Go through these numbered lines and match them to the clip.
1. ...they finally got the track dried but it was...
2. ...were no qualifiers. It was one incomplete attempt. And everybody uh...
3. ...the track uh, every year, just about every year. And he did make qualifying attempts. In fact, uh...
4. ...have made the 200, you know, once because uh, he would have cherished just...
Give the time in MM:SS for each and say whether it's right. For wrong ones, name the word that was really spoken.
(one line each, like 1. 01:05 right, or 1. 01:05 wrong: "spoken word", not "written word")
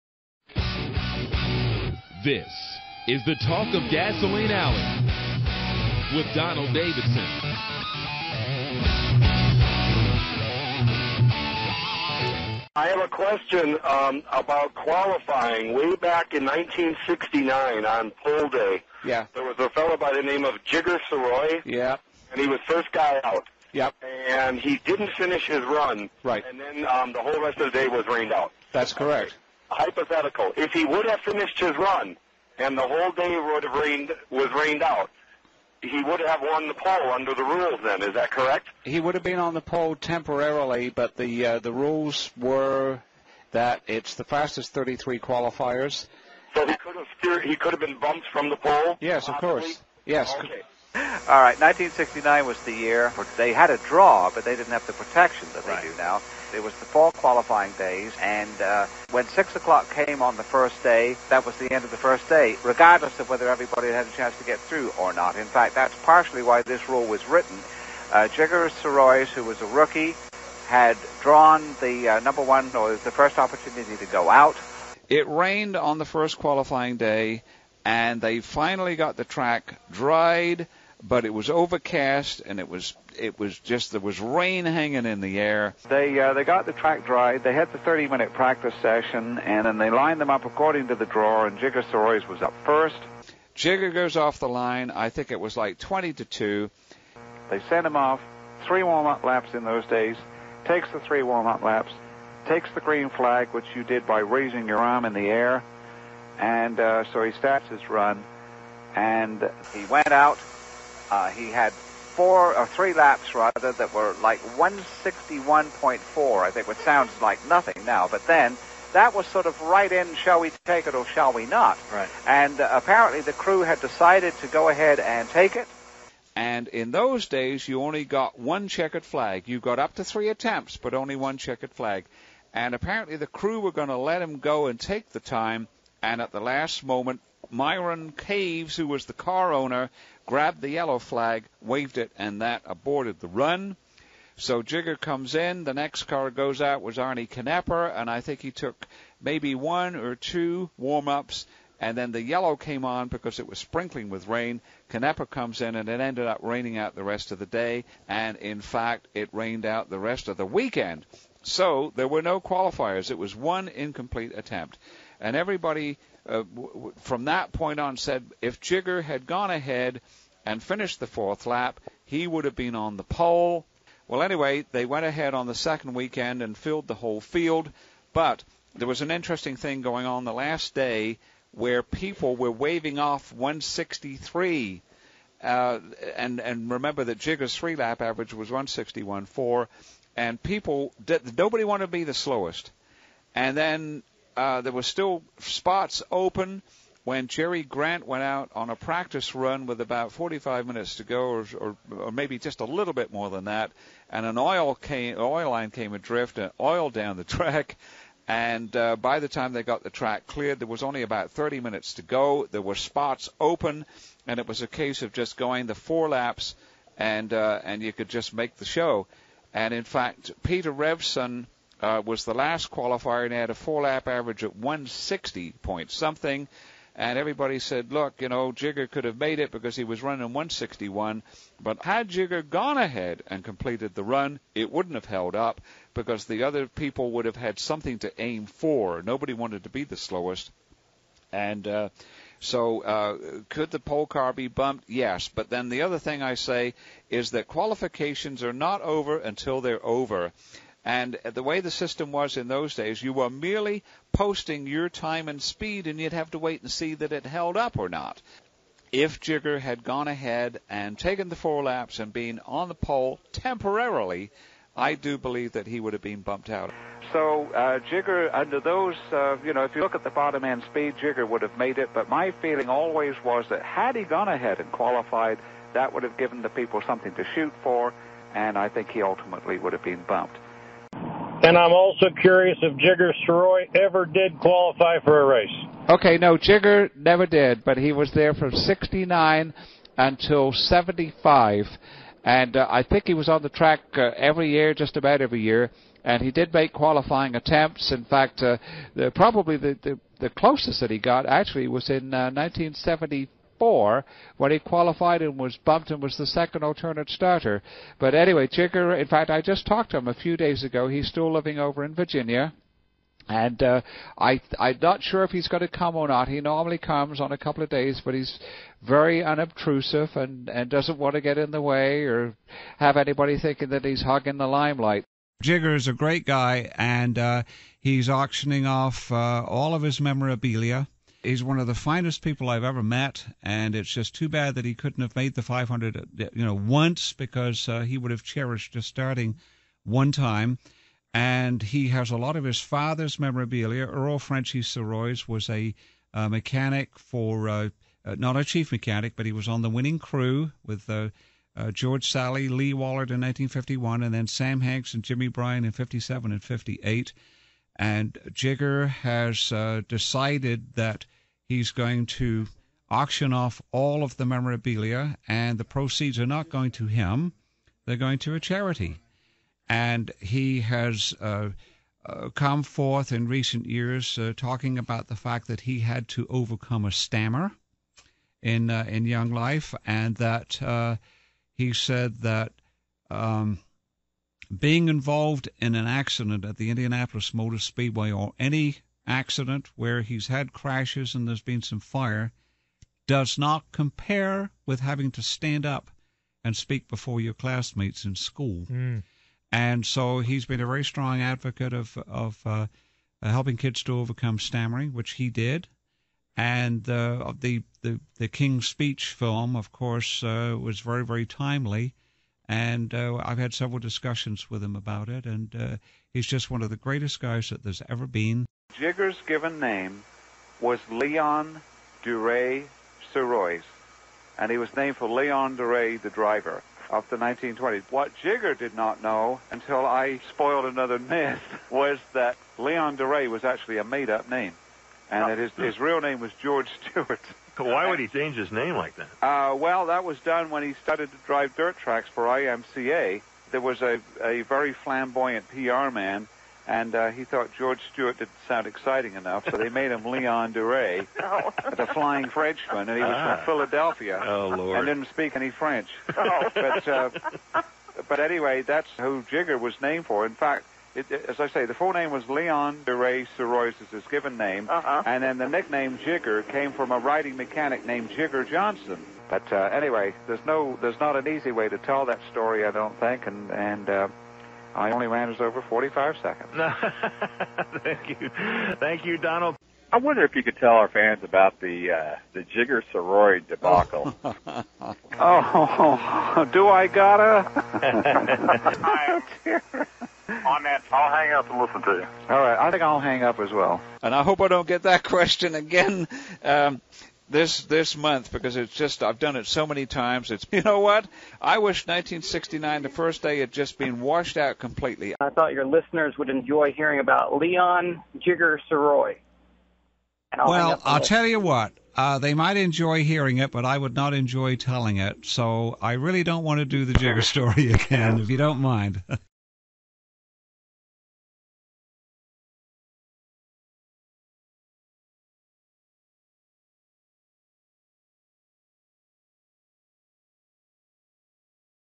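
1. 01:18 right
2. 02:42 right
3. 04:53 right
4. 05:35 wrong: "500", not "200".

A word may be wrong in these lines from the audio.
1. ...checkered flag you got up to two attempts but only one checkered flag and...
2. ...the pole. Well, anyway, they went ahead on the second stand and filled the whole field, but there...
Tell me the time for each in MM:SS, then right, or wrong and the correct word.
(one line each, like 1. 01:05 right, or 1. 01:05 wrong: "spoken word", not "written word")
1. 02:08 wrong: "three", not "two"
2. 02:52 wrong: "weekend", not "stand".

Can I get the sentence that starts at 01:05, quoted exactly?
In fact, that's partially why this rule was written.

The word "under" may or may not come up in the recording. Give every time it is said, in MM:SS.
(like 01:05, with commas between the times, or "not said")
00:37, 04:28.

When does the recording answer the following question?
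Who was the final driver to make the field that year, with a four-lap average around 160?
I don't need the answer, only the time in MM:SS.
03:40.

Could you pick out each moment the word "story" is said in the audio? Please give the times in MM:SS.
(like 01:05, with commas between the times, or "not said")
07:52, 08:37.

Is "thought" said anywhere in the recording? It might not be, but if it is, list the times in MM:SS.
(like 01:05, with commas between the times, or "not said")
07:27, 08:25.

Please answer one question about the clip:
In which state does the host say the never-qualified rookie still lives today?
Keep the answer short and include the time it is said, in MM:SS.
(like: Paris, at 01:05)
Virginia, at 05:11.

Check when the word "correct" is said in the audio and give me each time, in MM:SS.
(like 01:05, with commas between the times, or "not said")
00:28, 00:38.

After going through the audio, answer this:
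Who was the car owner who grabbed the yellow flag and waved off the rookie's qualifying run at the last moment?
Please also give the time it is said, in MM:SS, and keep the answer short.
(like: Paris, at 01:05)
Myron Caves, at 02:17.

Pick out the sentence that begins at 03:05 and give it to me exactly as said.
Uh, and and remember that Jigger's three lap average was 161.4, and people did, nobody wanted to be the slowest.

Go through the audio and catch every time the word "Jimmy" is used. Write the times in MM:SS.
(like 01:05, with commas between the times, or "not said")
05:55.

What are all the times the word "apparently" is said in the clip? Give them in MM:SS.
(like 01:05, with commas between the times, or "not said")
02:02, 02:12.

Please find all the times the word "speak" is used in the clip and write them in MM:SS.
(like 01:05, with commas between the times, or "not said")
06:36, 07:35.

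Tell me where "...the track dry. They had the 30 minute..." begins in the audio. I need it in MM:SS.
01:26.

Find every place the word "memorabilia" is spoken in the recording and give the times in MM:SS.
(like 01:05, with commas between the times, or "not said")
05:30, 05:43, 06:04.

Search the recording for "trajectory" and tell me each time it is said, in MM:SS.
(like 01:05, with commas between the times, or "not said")
not said.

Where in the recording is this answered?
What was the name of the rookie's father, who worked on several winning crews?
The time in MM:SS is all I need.
05:43.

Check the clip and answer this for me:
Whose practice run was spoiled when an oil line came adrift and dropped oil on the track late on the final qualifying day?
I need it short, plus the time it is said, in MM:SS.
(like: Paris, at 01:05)
Jerry Grant, at 03:17.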